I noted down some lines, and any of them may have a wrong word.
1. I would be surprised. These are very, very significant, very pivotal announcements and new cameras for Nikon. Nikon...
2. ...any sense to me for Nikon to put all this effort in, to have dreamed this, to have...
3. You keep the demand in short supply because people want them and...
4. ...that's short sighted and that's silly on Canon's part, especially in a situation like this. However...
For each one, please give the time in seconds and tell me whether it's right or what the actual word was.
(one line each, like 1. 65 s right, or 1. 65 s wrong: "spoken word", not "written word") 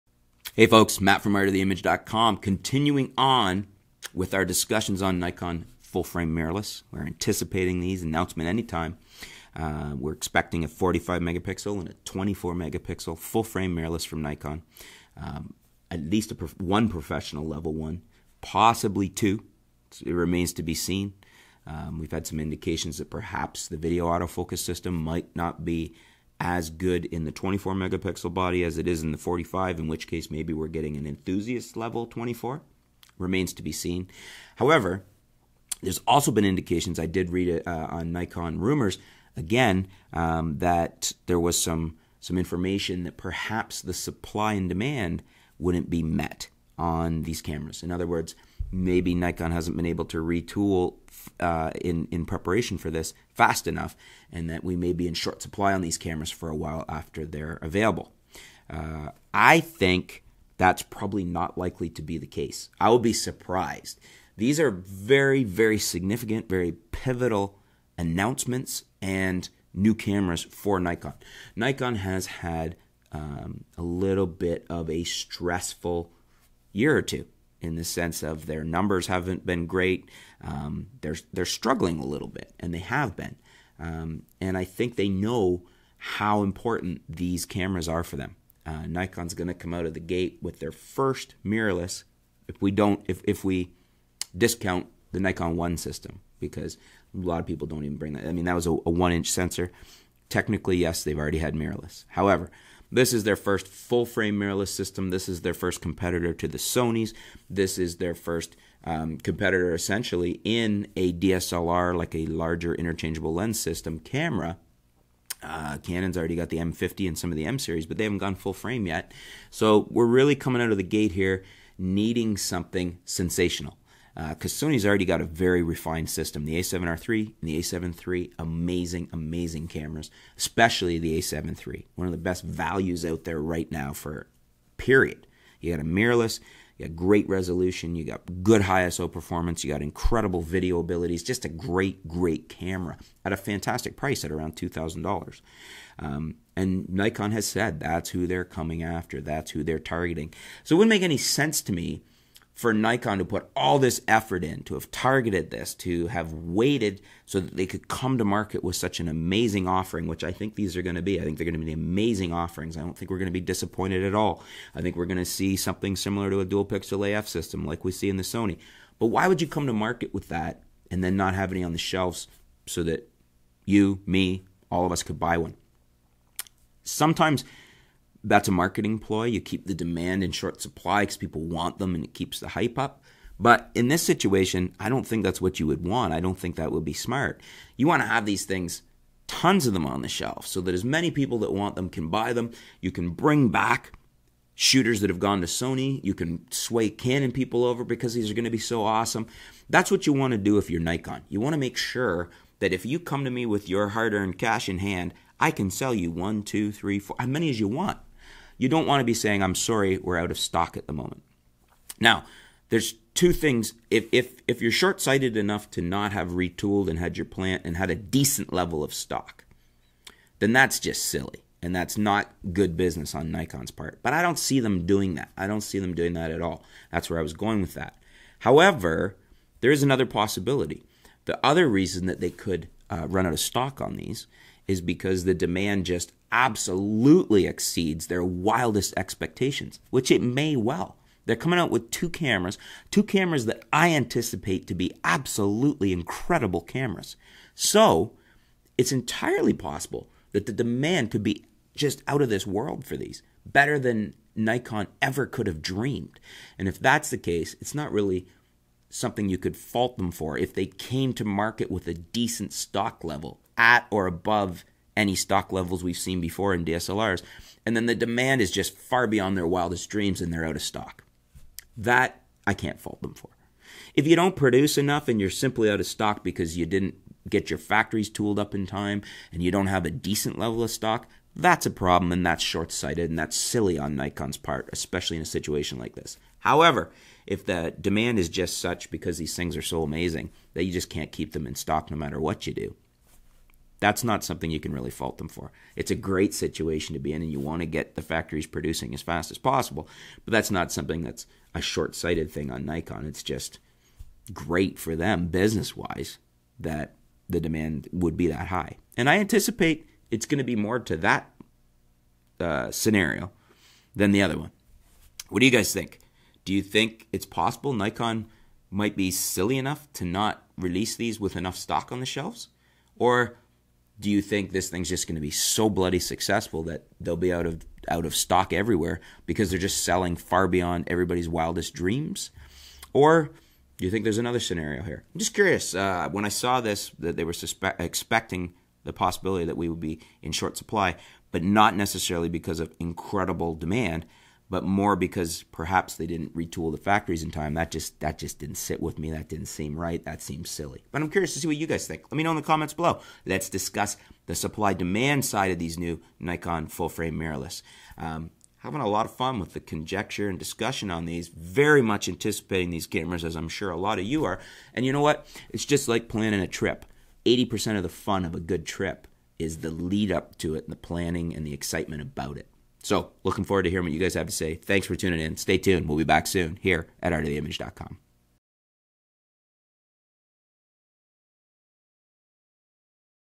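1. 62 s right
2. 151 s wrong: "targeted", not "dreamed"
3. 179 s right
4. 282 s wrong: "Nikon", not "Canon".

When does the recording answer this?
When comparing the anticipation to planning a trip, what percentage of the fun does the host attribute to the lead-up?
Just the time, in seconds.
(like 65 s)
367 s.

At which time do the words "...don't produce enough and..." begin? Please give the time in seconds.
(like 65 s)
274 s.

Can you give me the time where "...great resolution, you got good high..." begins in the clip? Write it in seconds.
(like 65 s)
136 s.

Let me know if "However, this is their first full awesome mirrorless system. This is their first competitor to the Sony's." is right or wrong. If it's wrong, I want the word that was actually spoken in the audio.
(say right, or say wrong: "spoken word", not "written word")
wrong: "frame", not "awesome".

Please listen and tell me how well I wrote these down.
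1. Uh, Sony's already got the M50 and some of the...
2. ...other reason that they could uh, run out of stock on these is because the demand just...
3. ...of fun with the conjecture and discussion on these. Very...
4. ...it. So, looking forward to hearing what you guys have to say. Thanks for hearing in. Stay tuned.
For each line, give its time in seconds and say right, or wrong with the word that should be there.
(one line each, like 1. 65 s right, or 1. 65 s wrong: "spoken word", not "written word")
1. 115 s wrong: "Canon", not "Sony"
2. 231 s right
3. 359 s right
4. 372 s wrong: "tuning", not "hearing".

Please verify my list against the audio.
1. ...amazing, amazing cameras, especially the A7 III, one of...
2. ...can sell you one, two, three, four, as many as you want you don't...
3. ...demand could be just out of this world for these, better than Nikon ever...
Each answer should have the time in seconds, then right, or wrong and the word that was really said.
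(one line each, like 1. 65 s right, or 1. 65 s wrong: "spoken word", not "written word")
1. 128 s right
2. 205 s right
3. 250 s right.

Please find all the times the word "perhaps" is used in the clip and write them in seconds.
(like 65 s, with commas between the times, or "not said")
23 s, 43 s, 345 s.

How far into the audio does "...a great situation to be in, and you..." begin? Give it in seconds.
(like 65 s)
295 s.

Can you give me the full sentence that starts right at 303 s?
It's just great for them business wise that the demand would be that high.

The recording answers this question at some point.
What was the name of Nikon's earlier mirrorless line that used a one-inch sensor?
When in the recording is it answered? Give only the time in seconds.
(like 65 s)
95 s.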